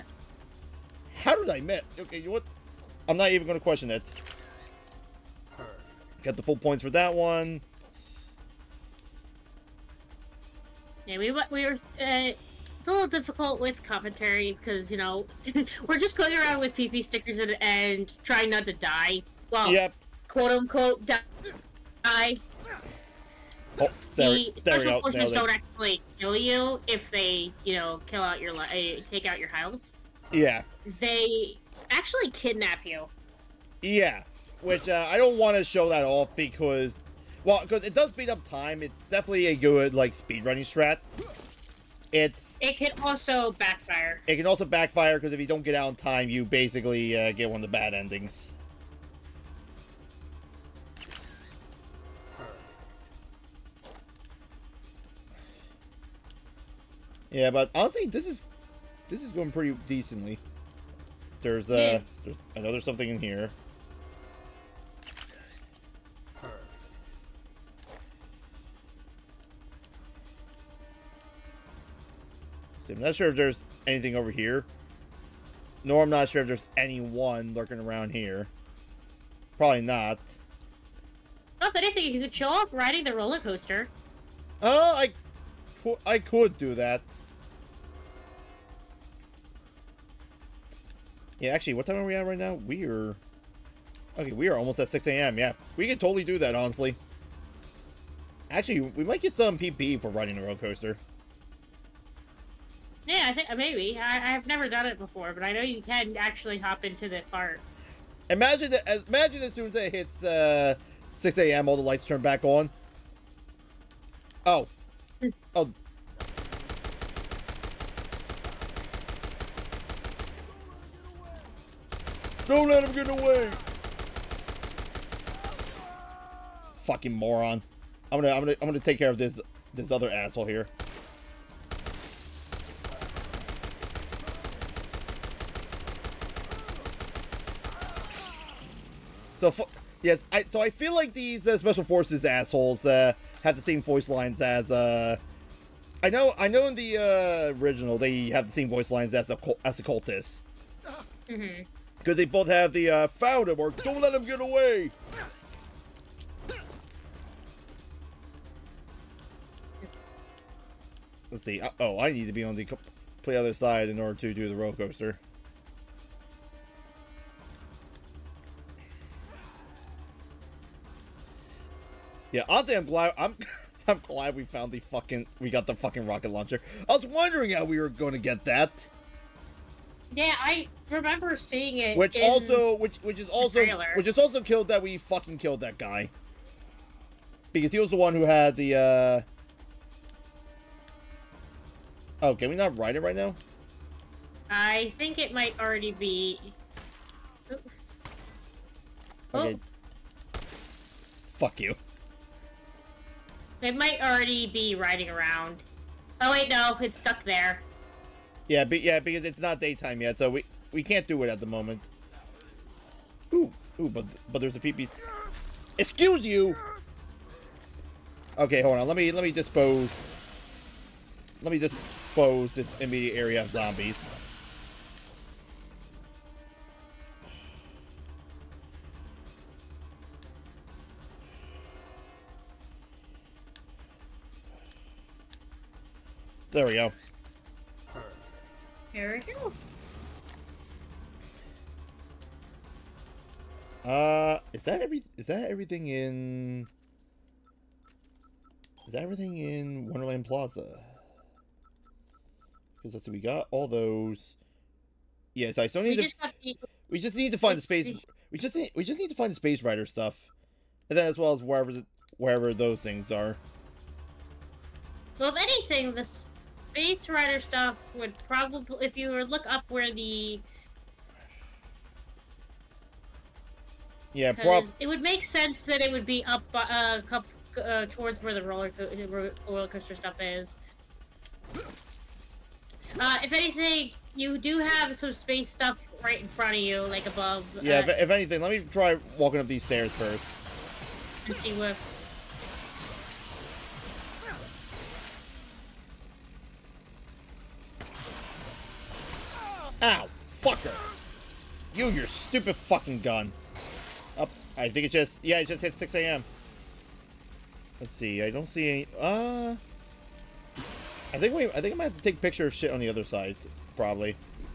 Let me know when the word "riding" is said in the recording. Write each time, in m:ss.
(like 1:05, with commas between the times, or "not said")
1:22, 1:40, 3:24.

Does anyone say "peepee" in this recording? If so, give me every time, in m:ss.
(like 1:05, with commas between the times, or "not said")
3:34.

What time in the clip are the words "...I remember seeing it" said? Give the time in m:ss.
3:00.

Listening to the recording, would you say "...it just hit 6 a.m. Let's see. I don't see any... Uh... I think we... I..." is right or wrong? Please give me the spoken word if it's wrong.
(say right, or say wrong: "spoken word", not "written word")
right.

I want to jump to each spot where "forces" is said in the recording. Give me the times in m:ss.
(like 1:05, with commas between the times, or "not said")
0:25, 2:21.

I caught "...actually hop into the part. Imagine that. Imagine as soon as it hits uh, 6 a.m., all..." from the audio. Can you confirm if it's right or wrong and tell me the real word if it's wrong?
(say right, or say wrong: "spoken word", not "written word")
right.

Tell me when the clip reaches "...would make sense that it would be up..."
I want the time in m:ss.
4:34.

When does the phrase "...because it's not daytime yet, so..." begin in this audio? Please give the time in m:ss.
3:28.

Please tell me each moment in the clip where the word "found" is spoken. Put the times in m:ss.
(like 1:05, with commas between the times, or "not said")
2:33, 2:54.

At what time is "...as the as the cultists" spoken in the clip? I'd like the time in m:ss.
2:29.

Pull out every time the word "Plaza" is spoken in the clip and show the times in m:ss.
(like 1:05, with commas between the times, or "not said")
4:10.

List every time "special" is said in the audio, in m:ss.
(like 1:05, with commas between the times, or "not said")
0:24, 2:21.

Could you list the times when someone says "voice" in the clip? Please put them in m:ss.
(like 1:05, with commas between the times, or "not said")
2:23, 2:28.